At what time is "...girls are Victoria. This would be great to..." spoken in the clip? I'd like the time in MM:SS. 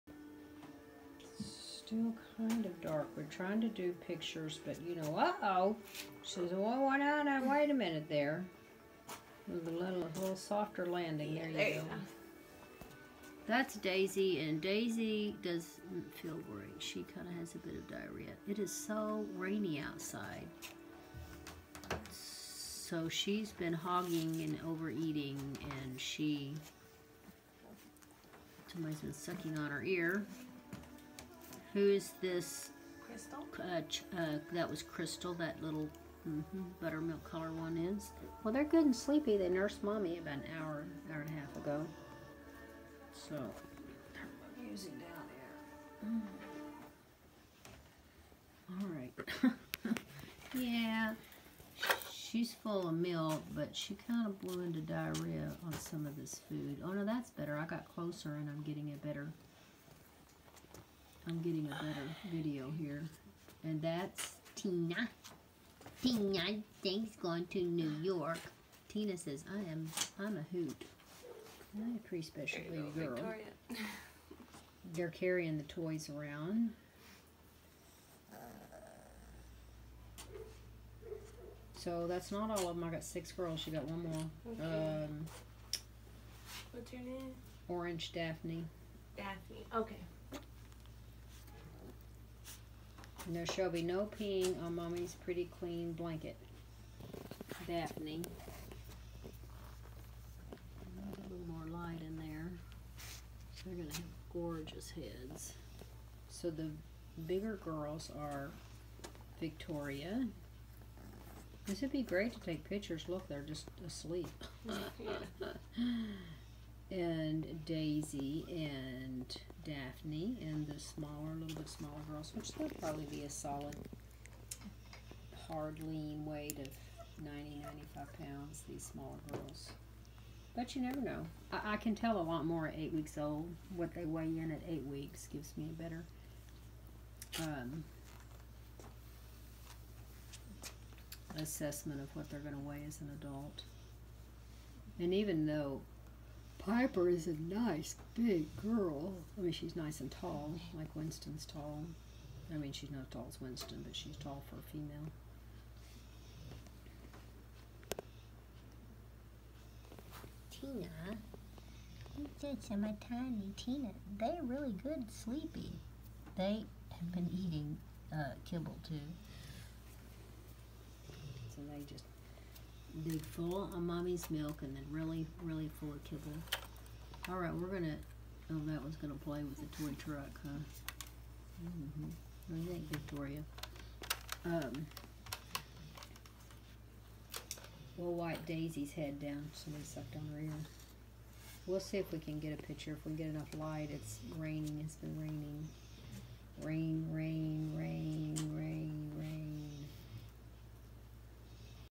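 01:47.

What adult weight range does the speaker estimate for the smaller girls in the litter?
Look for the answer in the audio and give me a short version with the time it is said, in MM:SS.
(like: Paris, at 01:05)
90 to 95 pounds, at 02:07.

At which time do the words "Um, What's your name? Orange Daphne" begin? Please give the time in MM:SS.
01:25.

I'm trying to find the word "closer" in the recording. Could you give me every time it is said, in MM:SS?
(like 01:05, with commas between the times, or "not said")
00:57.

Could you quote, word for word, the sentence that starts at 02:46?
They have been eating uh, kibble too.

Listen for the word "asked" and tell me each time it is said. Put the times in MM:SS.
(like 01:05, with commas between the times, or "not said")
not said.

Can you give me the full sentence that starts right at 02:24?
And even though Piper is a nice big girl.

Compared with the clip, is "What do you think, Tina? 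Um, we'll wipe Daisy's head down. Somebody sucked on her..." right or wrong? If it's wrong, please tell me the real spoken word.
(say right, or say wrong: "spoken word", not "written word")
wrong: "Victoria", not "Tina".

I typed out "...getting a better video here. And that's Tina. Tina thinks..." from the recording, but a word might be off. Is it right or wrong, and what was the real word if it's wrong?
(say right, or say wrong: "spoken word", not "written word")
right.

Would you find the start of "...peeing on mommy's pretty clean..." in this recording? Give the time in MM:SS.
01:34.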